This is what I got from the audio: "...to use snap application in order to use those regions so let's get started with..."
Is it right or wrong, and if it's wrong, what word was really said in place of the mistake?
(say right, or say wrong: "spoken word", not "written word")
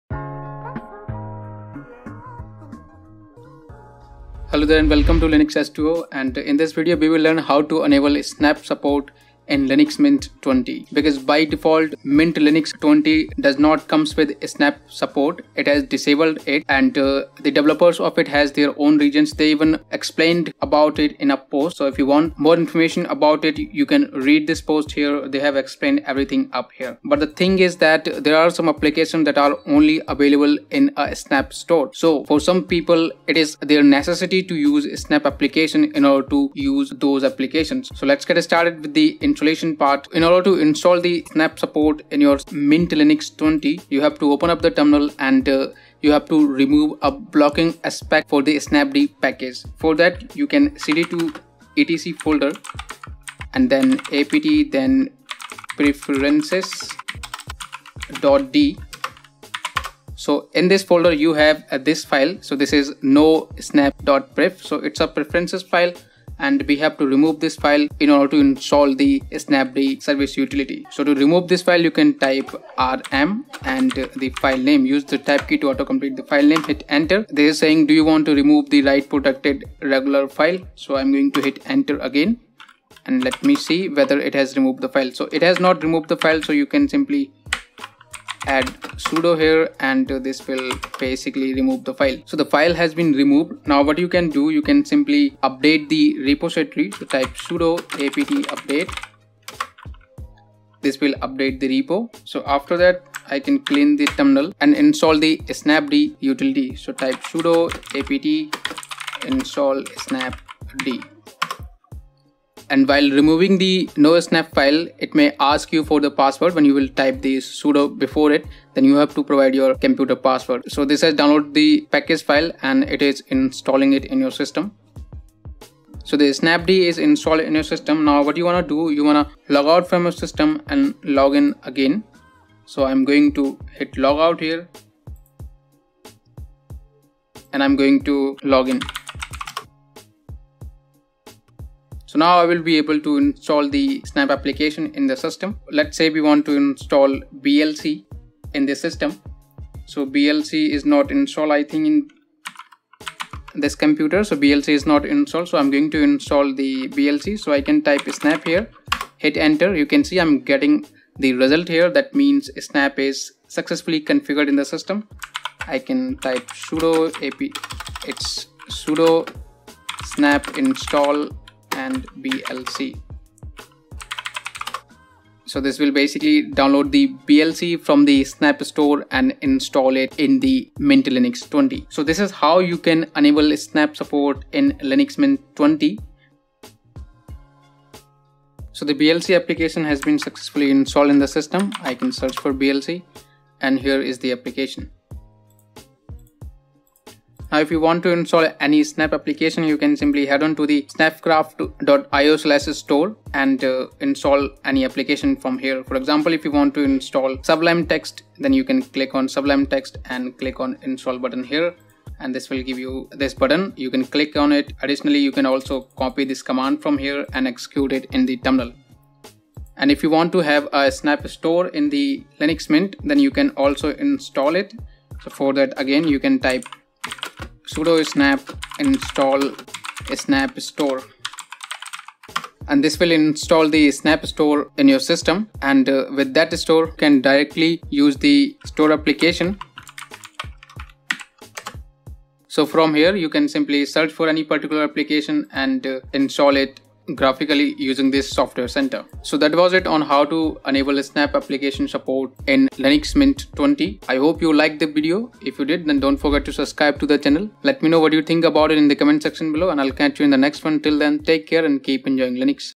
wrong: "applications", not "regions".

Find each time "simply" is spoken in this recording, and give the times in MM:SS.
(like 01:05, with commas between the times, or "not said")
01:26, 01:34, 03:19, 04:03.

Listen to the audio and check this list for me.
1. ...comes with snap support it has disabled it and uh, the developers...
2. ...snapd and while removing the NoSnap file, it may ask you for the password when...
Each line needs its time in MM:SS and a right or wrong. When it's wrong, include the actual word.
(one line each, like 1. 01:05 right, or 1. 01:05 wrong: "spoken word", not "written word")
1. 00:13 right
2. 01:49 right.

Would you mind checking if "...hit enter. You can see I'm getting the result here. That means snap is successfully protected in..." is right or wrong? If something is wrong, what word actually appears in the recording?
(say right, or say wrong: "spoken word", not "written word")
wrong: "configured", not "protected".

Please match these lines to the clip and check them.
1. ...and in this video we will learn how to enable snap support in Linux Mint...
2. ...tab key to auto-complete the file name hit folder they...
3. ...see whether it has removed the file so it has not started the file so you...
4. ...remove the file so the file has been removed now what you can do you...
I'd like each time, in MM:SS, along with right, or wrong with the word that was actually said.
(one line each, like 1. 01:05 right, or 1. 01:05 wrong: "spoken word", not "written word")
1. 00:06 right
2. 01:15 wrong: "enter", not "folder"
3. 01:23 wrong: "removed", not "started"
4. 01:31 right.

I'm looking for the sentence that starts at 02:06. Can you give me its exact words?
So the snapd is installed in your system.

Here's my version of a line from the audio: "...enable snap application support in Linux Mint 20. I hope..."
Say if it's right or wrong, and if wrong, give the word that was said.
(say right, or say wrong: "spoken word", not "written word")
right.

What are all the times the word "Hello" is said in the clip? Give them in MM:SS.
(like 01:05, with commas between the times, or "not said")
00:04.